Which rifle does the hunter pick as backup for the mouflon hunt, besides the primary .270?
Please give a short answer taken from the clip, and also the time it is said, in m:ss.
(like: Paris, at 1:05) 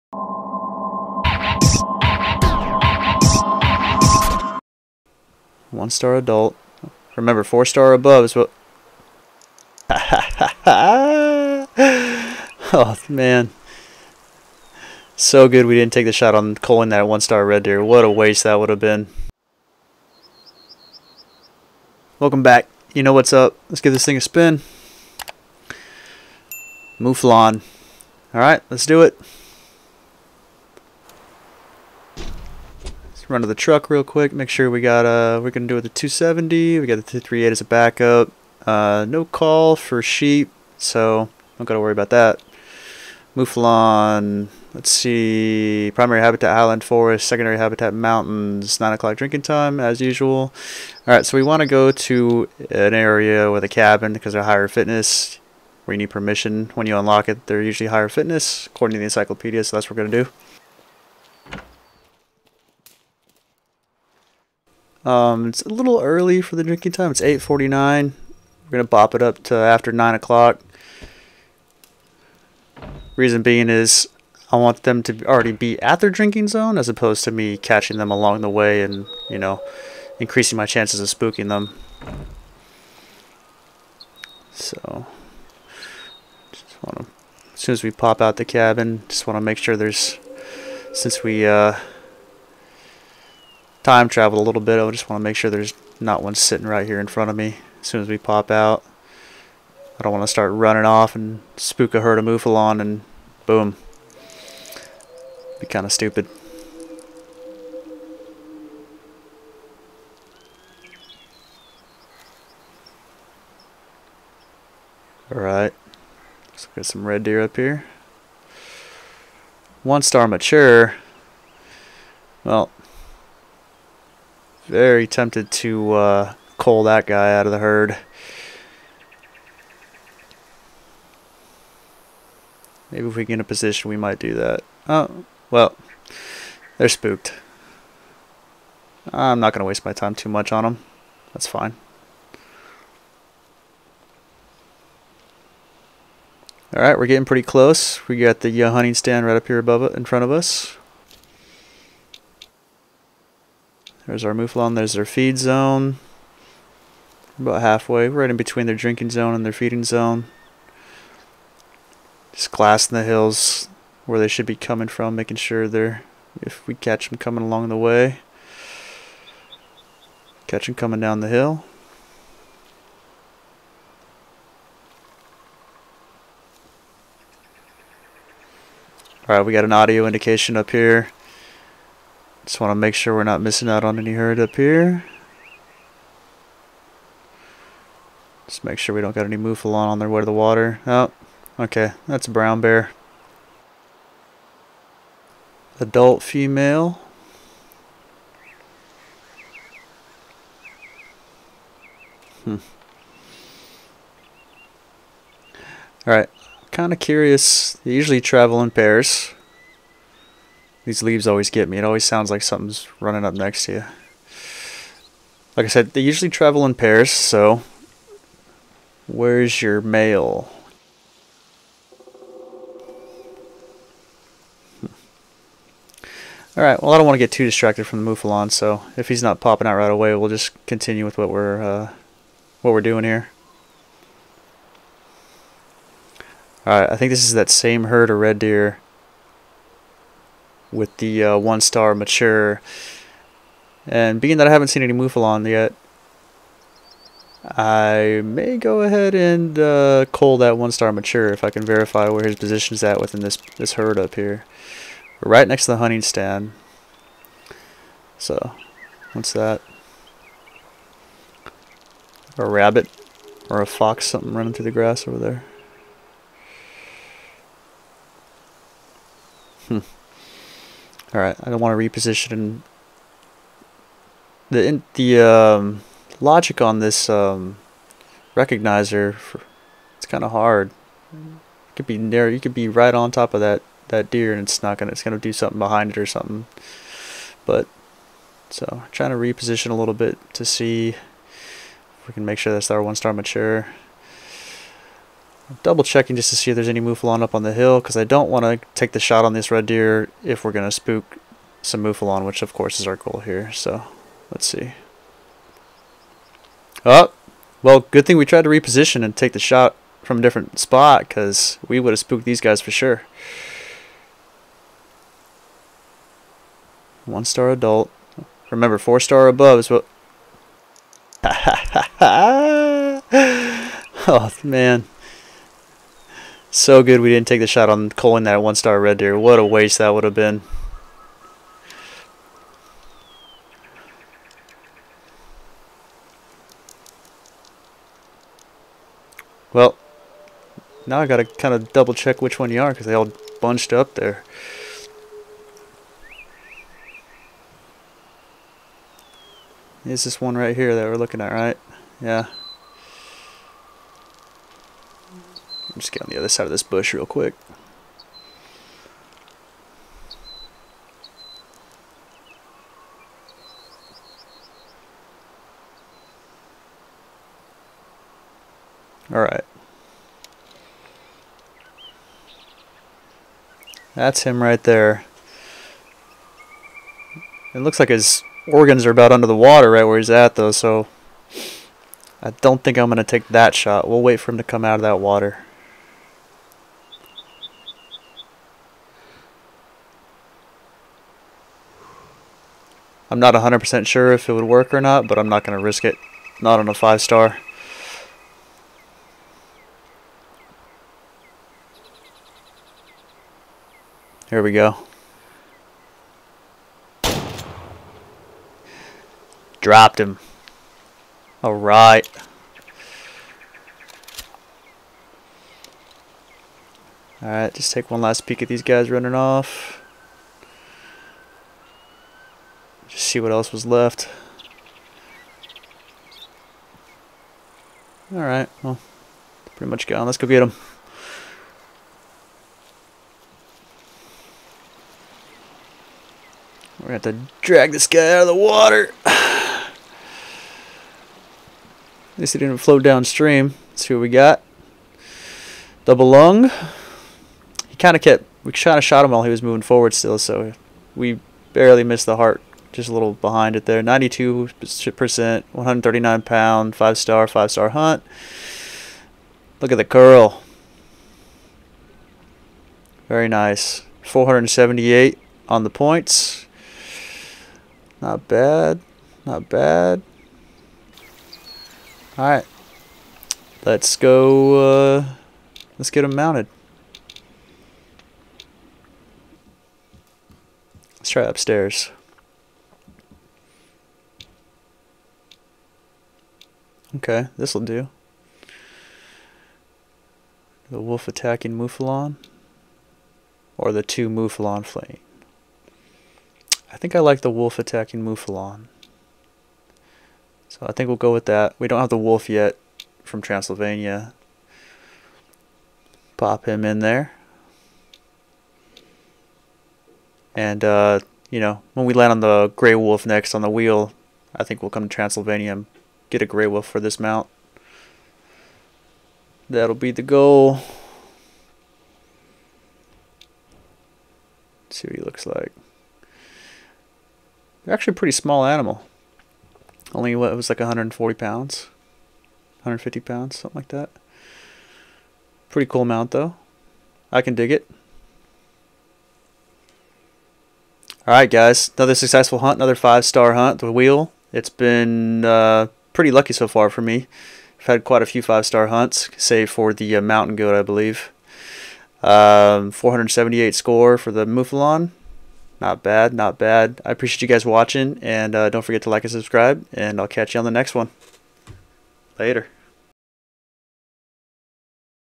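238, at 0:37.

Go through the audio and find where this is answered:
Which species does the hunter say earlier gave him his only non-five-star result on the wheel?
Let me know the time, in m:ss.
9:10.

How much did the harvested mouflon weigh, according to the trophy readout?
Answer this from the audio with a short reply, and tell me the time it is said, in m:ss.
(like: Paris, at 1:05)
139 pounds, at 7:35.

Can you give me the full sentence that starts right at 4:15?
right next to the hunting stand.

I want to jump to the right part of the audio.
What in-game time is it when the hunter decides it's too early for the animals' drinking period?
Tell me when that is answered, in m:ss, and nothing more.
1:07.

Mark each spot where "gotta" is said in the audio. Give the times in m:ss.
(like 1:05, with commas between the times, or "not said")
0:41, 5:41.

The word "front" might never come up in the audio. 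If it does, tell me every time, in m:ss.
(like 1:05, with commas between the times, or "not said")
1:37, 2:30.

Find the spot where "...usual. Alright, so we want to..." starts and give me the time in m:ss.
0:50.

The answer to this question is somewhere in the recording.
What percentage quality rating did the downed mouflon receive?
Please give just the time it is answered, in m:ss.
7:33.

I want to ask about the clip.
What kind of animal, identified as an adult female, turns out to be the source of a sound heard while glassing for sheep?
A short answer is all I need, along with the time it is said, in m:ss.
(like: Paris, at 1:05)
Brown bear, at 3:12.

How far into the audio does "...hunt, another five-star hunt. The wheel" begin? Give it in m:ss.
9:02.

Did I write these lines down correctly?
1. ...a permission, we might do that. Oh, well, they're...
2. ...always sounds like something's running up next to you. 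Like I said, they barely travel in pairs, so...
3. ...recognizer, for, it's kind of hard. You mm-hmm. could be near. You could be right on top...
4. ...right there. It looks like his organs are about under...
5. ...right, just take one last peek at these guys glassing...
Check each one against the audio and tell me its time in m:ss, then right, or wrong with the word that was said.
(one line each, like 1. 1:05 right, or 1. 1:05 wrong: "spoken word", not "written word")
1. 2:13 wrong: "position", not "permission"
2. 3:31 wrong: "usually", not "barely"
3. 4:38 right
4. 6:14 right
5. 6:57 wrong: "running", not "glassing".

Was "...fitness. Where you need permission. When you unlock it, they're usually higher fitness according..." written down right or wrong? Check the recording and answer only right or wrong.
right.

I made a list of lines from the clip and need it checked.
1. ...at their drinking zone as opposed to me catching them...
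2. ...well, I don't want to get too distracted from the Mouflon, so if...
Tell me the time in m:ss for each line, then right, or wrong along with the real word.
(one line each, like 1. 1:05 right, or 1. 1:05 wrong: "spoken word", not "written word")
1. 1:15 right
2. 3:46 right.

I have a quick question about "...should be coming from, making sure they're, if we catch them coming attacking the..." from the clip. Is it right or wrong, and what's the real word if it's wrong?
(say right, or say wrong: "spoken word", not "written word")
wrong: "along", not "attacking".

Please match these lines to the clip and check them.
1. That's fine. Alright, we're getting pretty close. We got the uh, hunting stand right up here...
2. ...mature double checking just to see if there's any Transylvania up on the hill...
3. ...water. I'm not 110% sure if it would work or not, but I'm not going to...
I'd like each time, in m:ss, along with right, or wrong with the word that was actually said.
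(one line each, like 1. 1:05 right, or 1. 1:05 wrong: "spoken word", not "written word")
1. 2:21 right
2. 4:53 wrong: "Mouflon", not "Transylvania"
3. 6:25 wrong: "100", not "110".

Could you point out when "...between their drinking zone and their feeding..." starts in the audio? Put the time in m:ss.
2:38.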